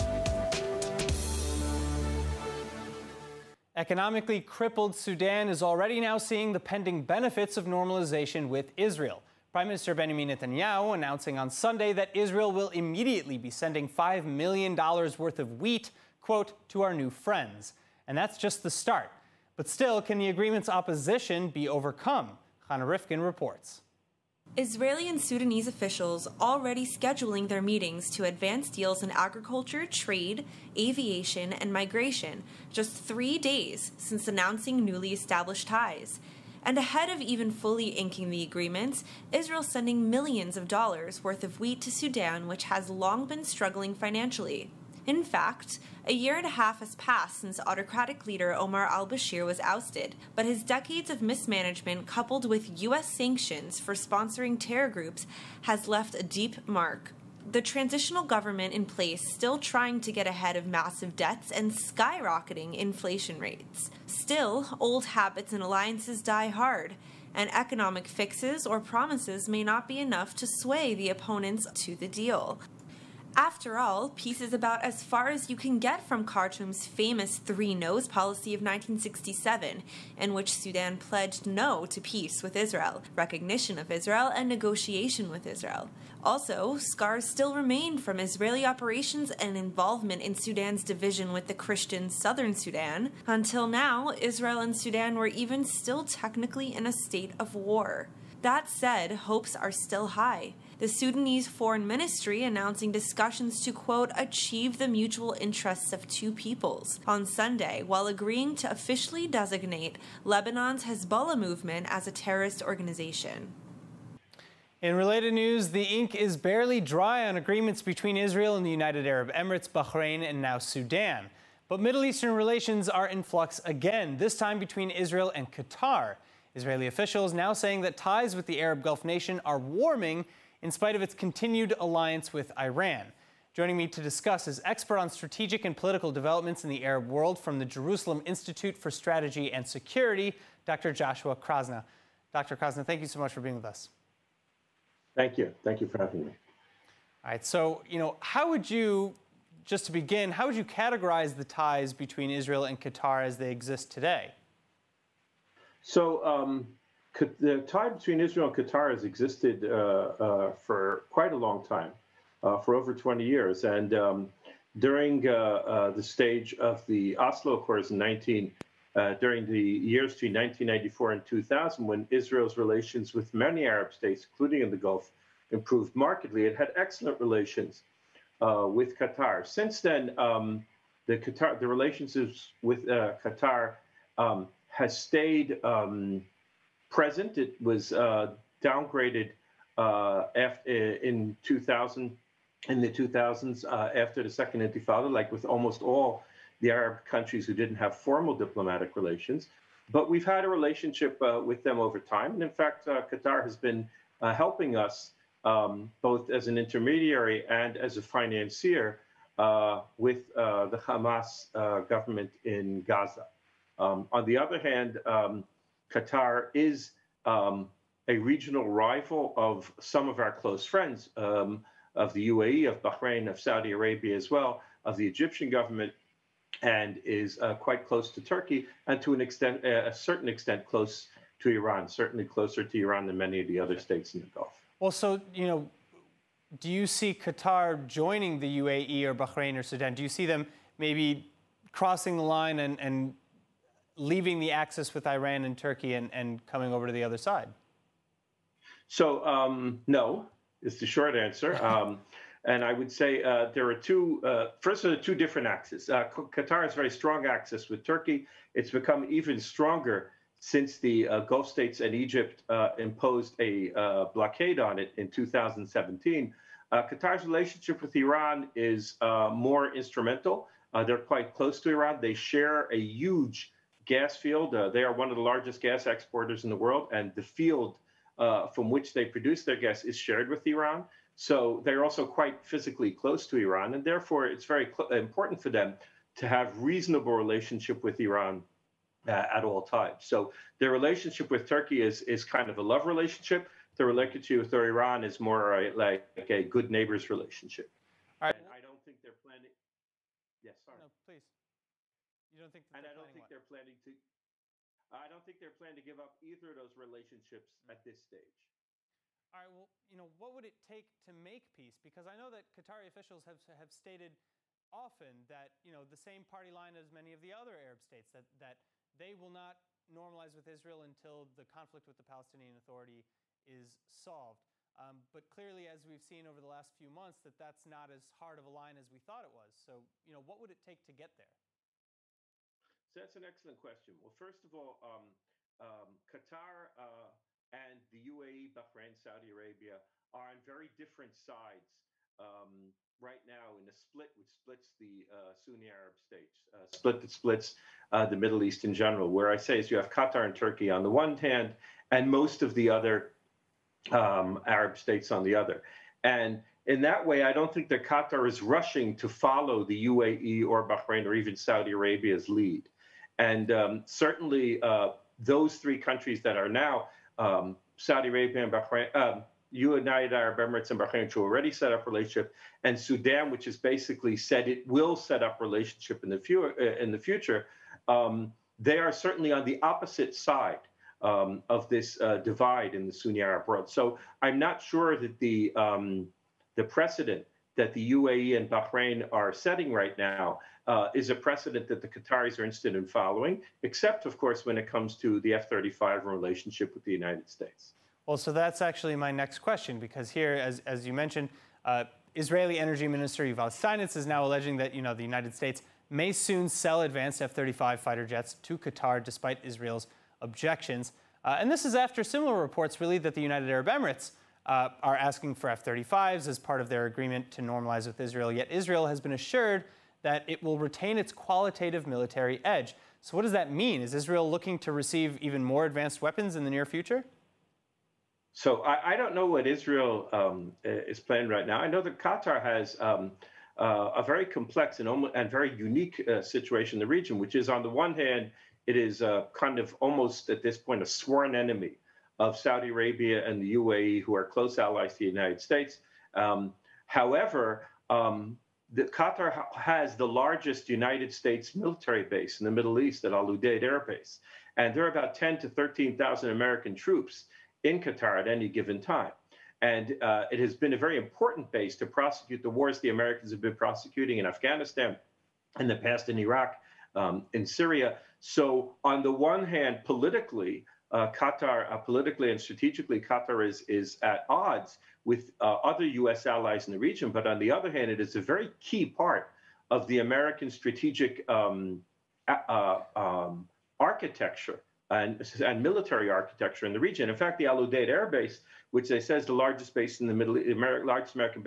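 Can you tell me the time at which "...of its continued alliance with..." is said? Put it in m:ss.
2:10.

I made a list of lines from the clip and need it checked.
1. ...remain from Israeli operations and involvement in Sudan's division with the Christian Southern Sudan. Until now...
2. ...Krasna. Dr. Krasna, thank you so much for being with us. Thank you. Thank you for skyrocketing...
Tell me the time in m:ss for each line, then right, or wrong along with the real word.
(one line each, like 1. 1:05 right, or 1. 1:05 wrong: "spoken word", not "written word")
1. 1:27 right
2. 2:21 wrong: "having", not "skyrocketing".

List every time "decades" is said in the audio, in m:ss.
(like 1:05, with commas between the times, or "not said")
0:50.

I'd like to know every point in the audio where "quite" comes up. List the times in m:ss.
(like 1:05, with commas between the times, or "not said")
2:41, 3:47, 4:31, 4:42.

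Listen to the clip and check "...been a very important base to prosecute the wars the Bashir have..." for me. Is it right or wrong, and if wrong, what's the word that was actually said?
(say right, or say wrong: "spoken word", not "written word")
wrong: "Americans", not "Bashir".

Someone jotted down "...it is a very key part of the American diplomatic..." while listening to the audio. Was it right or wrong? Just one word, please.
wrong.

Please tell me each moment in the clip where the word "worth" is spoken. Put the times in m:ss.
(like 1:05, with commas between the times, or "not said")
0:14, 0:41.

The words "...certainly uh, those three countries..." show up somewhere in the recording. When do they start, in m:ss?
6:03.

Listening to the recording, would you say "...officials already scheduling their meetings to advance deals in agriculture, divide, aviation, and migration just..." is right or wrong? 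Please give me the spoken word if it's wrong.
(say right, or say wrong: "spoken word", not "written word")
wrong: "trade", not "divide".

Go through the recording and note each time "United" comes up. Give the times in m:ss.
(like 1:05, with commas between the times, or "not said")
1:58, 6:09, 6:36, 6:45, 6:53, 7:25, 7:30.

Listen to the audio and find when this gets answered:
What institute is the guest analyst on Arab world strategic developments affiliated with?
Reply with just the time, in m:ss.
2:17.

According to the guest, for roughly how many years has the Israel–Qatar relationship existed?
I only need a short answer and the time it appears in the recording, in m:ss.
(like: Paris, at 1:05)
over 20 years, at 2:42.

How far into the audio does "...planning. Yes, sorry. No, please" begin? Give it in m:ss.
4:59.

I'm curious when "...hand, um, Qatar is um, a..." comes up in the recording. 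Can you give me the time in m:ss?
3:34.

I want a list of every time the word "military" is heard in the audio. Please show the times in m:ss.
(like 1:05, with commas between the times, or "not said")
7:01, 7:31, 8:05.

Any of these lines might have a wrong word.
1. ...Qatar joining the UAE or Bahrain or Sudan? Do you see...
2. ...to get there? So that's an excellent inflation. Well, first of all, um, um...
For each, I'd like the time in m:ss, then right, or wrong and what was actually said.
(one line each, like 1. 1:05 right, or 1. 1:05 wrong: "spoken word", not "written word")
1. 3:57 right
2. 5:30 wrong: "question", not "inflation".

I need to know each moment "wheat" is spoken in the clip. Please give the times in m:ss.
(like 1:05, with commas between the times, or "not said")
0:15, 0:41.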